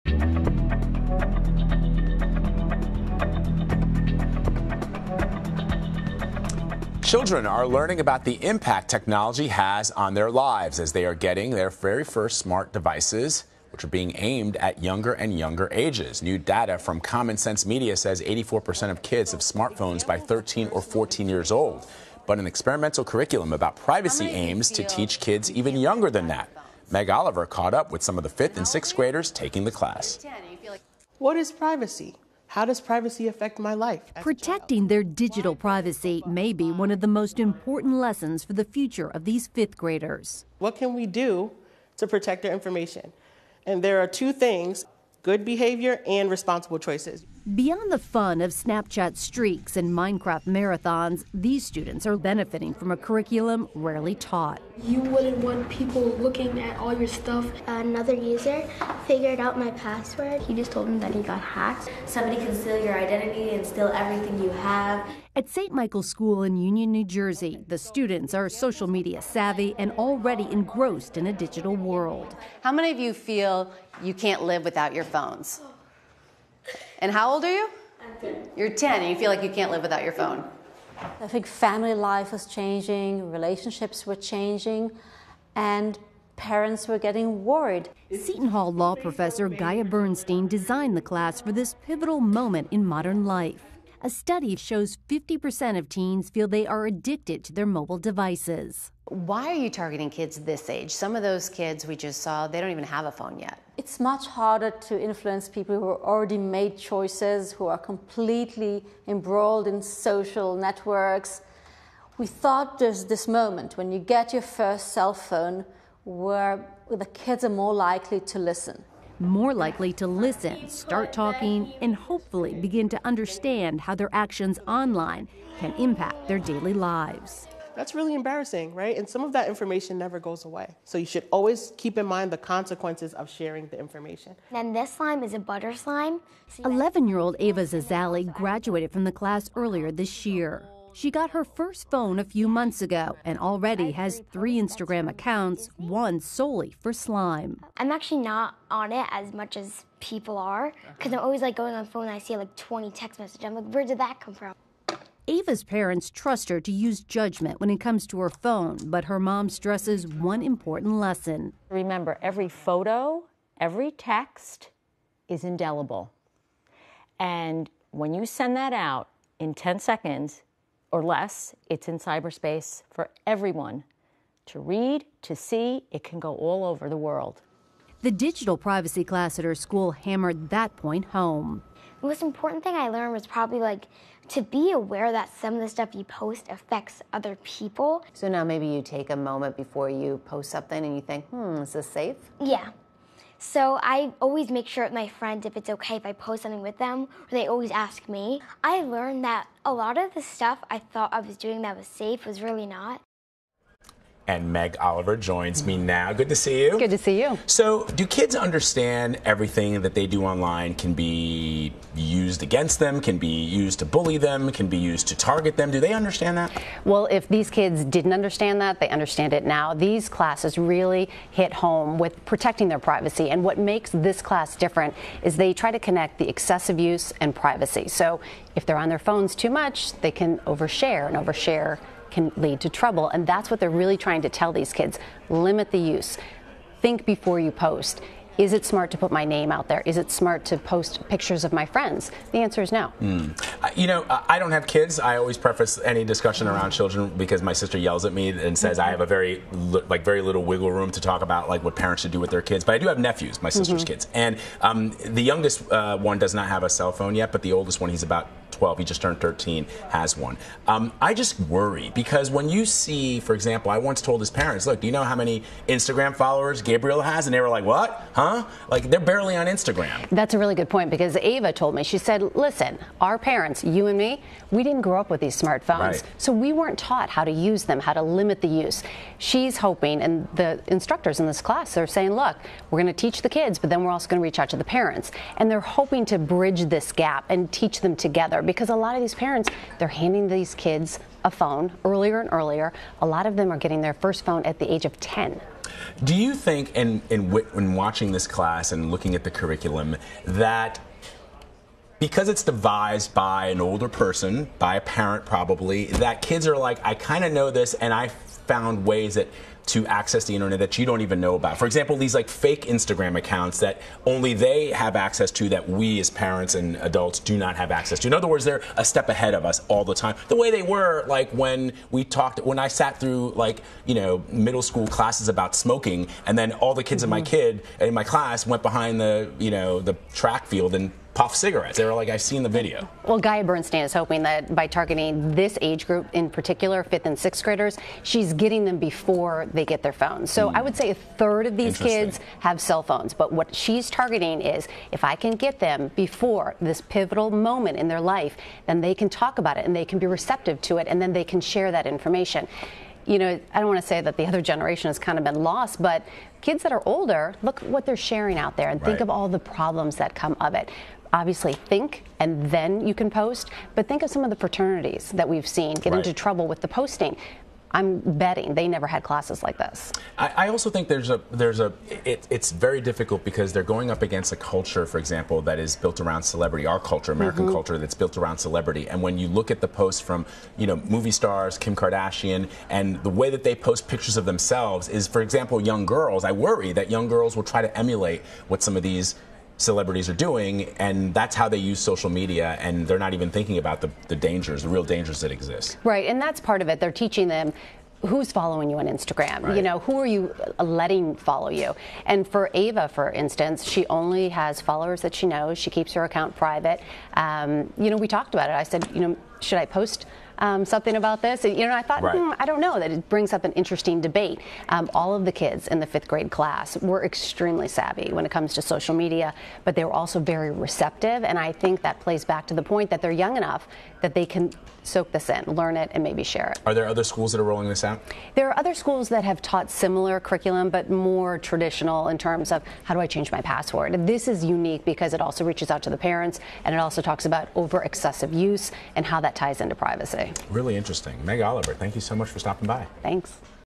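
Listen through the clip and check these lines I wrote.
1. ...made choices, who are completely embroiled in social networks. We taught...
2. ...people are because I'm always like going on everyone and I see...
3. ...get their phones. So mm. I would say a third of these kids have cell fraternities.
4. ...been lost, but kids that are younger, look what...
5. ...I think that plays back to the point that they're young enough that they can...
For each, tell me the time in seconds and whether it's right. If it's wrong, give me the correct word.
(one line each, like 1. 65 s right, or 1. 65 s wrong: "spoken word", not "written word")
1. 106 s wrong: "thought", not "taught"
2. 150 s wrong: "phone", not "everyone"
3. 339 s wrong: "phones", not "fraternities"
4. 355 s wrong: "older", not "younger"
5. 421 s right.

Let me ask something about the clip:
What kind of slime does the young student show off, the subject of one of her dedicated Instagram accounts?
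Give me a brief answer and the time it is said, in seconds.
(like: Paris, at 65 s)
butter slime, at 135 s.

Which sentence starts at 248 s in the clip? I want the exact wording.
I have a very like very little wiggle room to talk about like what parents should do with their kids.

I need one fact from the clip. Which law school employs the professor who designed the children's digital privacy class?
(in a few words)
Seton Hall.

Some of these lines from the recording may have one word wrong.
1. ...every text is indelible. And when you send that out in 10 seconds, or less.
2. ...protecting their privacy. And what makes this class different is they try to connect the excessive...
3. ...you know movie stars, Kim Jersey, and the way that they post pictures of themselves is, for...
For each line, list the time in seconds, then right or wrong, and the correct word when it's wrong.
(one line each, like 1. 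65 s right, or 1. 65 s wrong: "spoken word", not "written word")
1. 163 s right
2. 222 s right
3. 380 s wrong: "Kardashian", not "Jersey".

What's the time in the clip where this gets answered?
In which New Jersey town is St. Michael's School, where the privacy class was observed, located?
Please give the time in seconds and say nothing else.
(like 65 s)
66 s.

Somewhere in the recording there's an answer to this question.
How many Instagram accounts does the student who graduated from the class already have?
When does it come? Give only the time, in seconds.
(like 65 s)
144 s.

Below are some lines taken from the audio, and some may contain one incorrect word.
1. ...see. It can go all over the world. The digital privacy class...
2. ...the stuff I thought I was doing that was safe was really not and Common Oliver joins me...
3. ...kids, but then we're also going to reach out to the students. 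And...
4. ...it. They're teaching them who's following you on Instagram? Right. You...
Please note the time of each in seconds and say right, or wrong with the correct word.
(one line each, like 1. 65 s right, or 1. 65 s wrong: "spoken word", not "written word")
1. 175 s right
2. 200 s wrong: "Meg", not "Common"
3. 283 s wrong: "parents", not "students"
4. 396 s right.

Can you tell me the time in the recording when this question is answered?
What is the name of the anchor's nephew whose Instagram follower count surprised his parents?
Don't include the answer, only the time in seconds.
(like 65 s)
266 s.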